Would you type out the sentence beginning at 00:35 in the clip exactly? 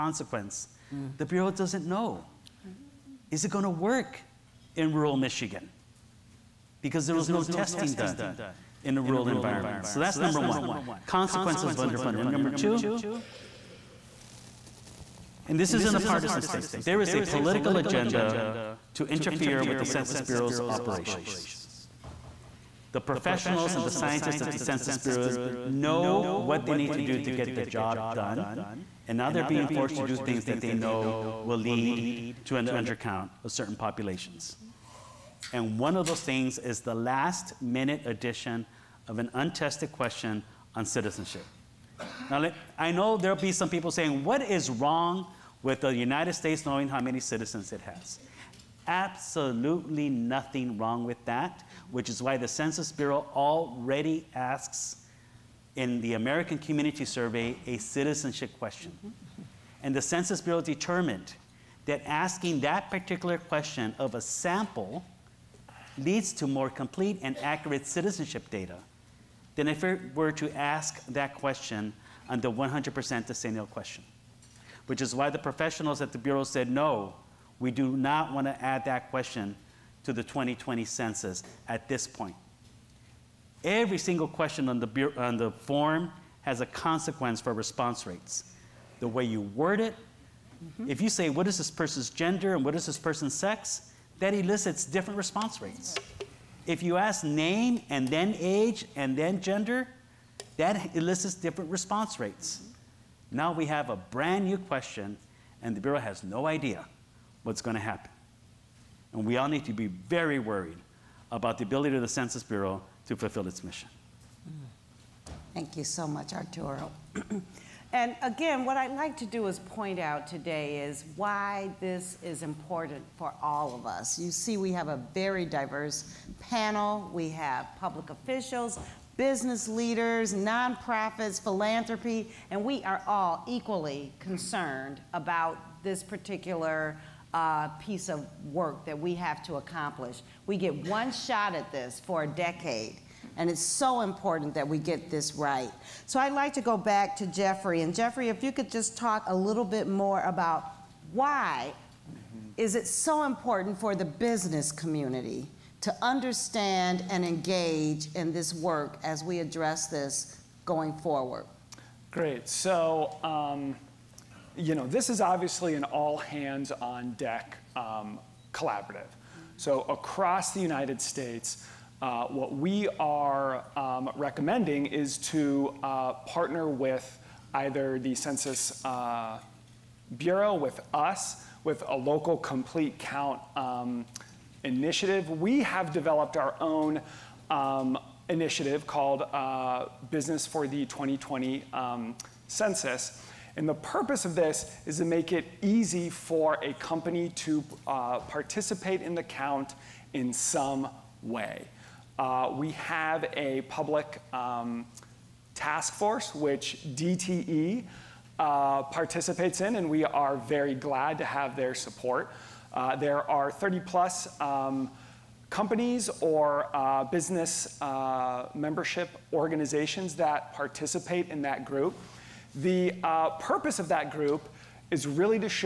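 And one of those things is the last minute addition of an untested question on citizenship.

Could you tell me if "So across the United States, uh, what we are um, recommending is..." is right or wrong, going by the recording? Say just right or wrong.
right.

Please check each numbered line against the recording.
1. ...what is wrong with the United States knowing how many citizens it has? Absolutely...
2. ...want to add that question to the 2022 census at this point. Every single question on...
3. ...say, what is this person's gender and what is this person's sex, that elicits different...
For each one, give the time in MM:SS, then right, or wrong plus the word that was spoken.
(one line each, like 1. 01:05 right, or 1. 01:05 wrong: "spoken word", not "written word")
1. 00:44 right
2. 01:18 wrong: "2020", not "2022"
3. 01:31 right.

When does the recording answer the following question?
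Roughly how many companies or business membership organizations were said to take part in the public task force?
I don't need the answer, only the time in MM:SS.
03:33.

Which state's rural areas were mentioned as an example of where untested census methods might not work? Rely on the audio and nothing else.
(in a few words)
Michigan.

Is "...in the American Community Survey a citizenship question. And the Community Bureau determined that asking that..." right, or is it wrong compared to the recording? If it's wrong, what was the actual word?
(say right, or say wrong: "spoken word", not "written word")
wrong: "Census", not "Community".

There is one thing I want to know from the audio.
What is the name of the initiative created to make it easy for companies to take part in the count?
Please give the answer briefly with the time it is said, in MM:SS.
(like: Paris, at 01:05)
Business for the 2020 Census, at 03:10.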